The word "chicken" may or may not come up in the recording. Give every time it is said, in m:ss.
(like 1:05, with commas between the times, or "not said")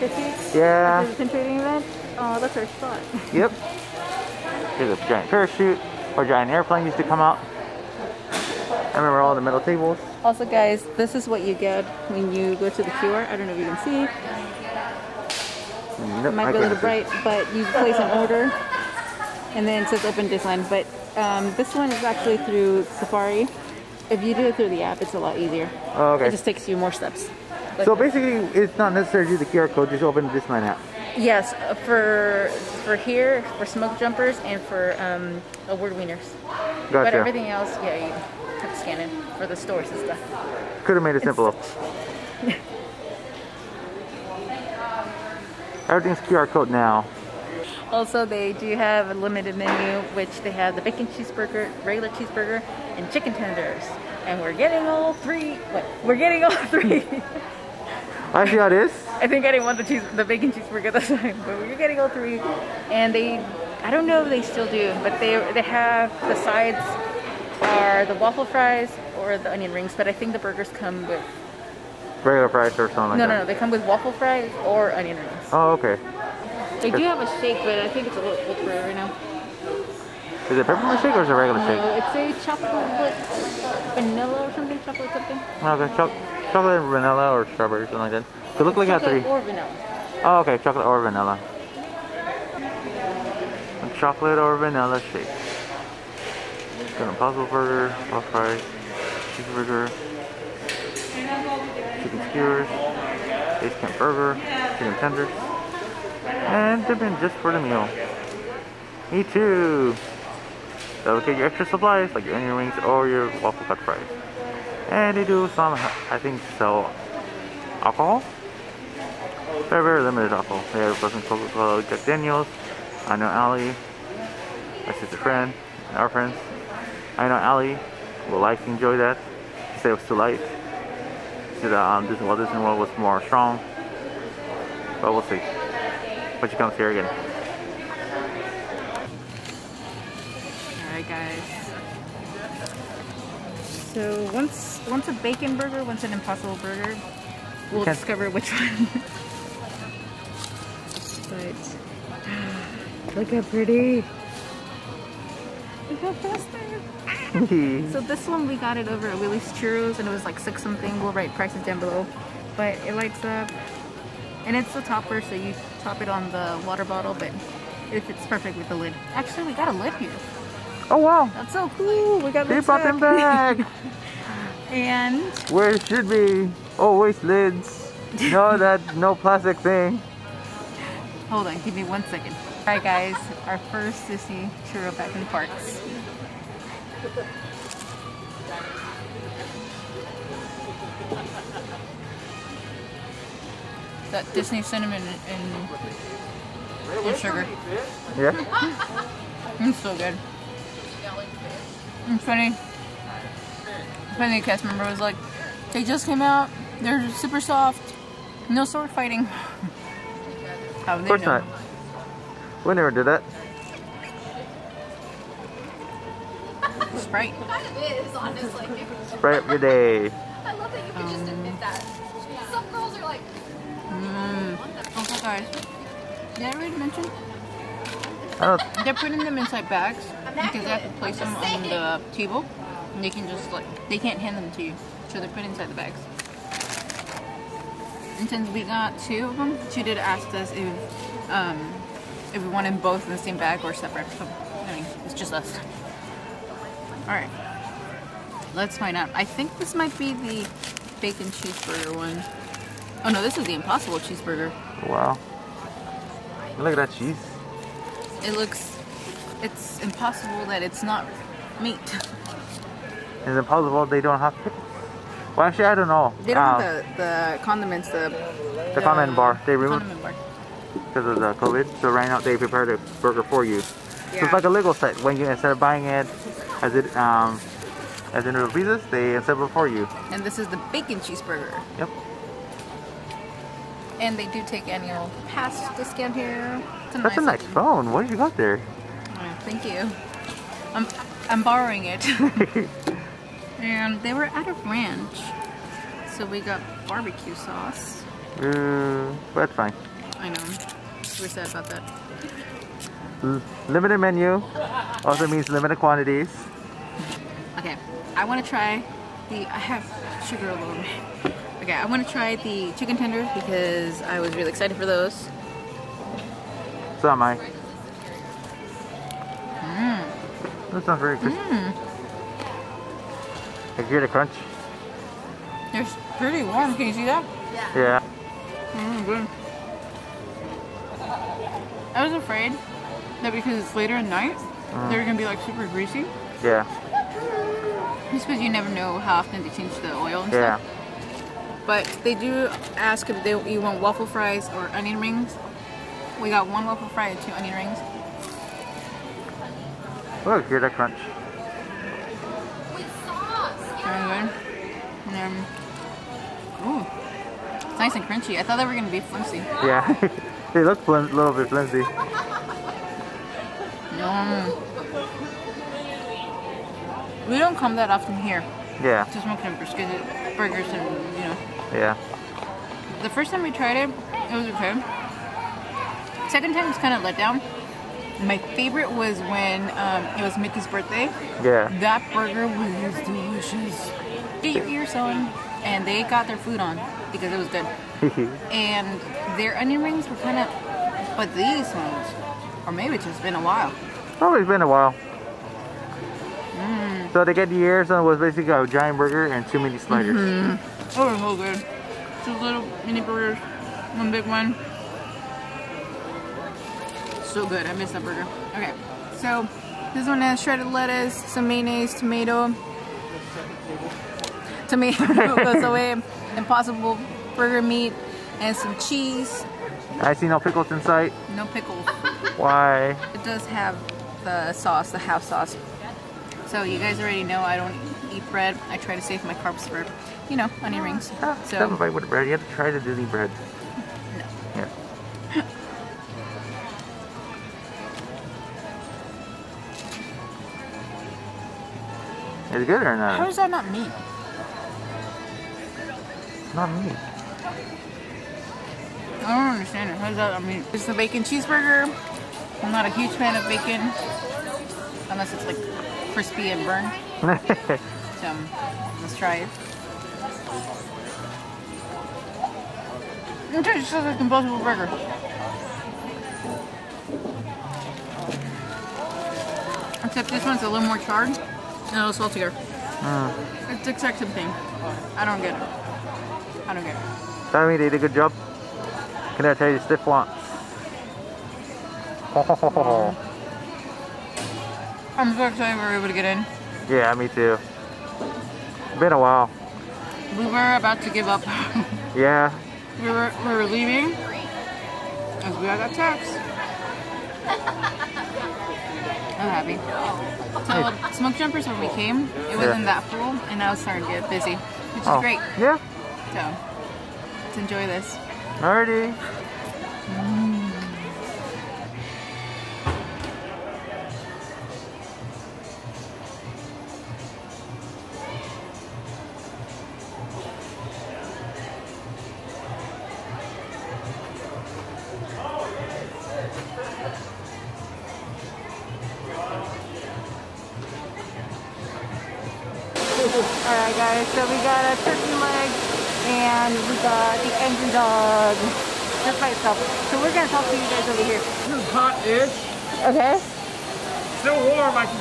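0:53, 1:44, 5:12.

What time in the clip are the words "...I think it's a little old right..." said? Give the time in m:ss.
1:17.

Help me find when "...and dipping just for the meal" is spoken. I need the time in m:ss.
1:46.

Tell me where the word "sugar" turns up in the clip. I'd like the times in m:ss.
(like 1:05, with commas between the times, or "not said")
3:17, 5:10.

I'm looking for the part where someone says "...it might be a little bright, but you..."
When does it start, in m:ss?
0:16.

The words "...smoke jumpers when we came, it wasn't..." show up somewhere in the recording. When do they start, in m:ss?
8:21.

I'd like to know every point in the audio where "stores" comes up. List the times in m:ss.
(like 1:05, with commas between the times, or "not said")
0:39.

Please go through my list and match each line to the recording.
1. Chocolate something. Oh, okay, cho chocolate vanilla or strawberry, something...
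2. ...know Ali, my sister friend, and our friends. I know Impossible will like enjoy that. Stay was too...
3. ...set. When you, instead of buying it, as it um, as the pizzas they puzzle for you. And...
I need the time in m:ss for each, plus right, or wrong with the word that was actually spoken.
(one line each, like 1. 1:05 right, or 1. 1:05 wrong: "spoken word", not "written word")
1. 1:24 right
2. 2:03 wrong: "Ali", not "Impossible"
3. 4:34 wrong: "assemble", not "puzzle".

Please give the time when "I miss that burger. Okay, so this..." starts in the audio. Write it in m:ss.
6:47.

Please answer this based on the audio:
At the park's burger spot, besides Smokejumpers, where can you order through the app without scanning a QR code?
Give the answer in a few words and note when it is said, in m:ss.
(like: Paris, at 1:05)
Award Wieners, at 0:35.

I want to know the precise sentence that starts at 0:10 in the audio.
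Also, guys, this is what you get when you go to the QR.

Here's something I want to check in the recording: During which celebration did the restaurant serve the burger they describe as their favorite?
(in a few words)
Mickey's birthday.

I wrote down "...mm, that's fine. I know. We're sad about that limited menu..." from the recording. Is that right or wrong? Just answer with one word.
right.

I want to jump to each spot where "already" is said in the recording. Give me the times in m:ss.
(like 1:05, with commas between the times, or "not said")
3:46, 7:07.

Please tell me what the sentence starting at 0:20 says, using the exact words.
But um, this one is actually through Safari.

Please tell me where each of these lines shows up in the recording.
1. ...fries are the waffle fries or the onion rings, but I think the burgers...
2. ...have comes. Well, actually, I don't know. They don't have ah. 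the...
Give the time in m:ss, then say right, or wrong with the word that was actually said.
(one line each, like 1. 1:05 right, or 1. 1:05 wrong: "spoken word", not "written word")
1. 1:06 wrong: "sides", not "fries"
2. 4:24 wrong: "pickles", not "comes".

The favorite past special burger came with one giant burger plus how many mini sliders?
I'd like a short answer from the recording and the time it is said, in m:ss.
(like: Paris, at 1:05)
2, at 6:39.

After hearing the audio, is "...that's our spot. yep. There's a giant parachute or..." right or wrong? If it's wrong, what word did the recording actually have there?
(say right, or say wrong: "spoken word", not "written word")
right.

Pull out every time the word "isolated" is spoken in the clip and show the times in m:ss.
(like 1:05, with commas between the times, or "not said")
not said.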